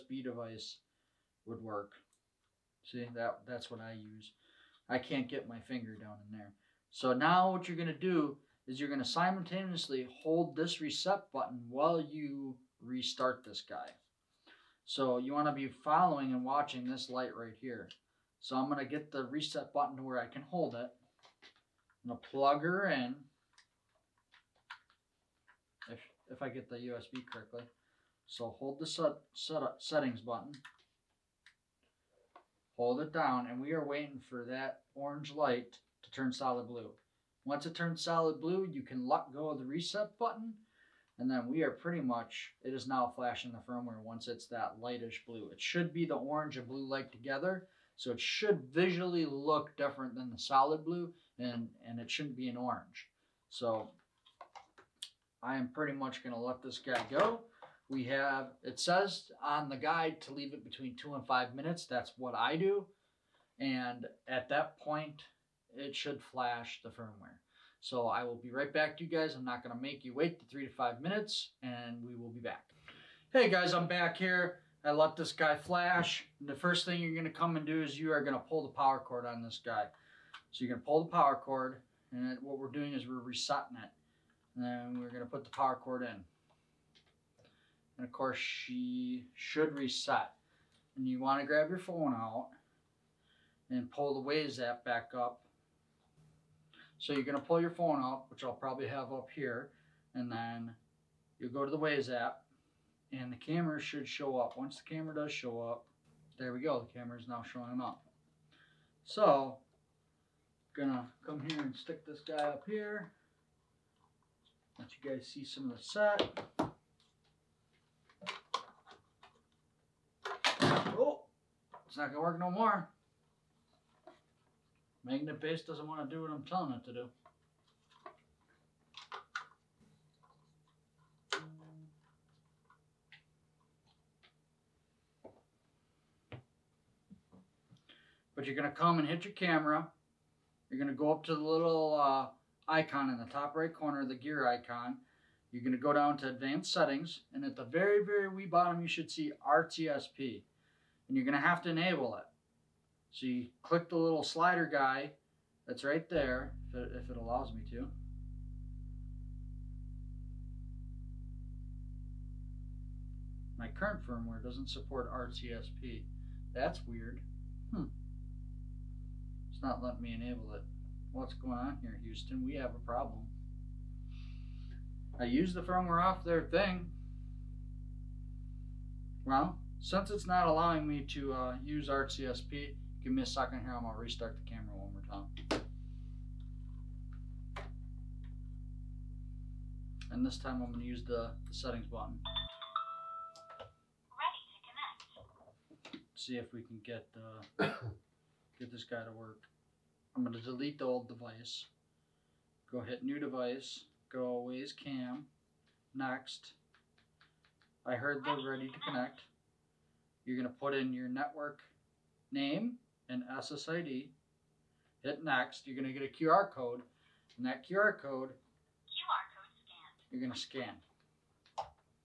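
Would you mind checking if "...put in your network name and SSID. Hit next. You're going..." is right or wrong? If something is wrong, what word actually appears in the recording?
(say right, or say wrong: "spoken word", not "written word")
right.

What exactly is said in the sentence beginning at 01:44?
Once the camera does show up, there we go.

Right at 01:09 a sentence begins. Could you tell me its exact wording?
I'm not going to make you wait the three to five minutes and we will be back.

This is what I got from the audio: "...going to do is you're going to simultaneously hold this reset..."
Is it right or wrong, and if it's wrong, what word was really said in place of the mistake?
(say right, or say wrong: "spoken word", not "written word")
right.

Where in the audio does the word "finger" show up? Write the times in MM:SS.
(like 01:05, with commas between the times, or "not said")
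00:05.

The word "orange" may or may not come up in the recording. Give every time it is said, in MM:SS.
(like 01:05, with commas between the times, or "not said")
00:34, 00:46, 00:52.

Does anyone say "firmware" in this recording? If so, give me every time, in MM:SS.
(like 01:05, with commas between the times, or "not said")
00:43, 01:06, 02:44, 02:55.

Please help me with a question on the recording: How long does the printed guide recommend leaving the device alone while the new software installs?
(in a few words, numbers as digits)
2 to 5 minutes.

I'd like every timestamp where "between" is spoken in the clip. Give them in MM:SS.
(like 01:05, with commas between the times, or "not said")
01:00.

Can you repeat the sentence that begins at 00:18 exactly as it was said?
So I'm going to get the reset button to where I can hold it.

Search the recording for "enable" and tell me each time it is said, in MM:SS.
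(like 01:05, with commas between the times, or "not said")
02:31, 02:50.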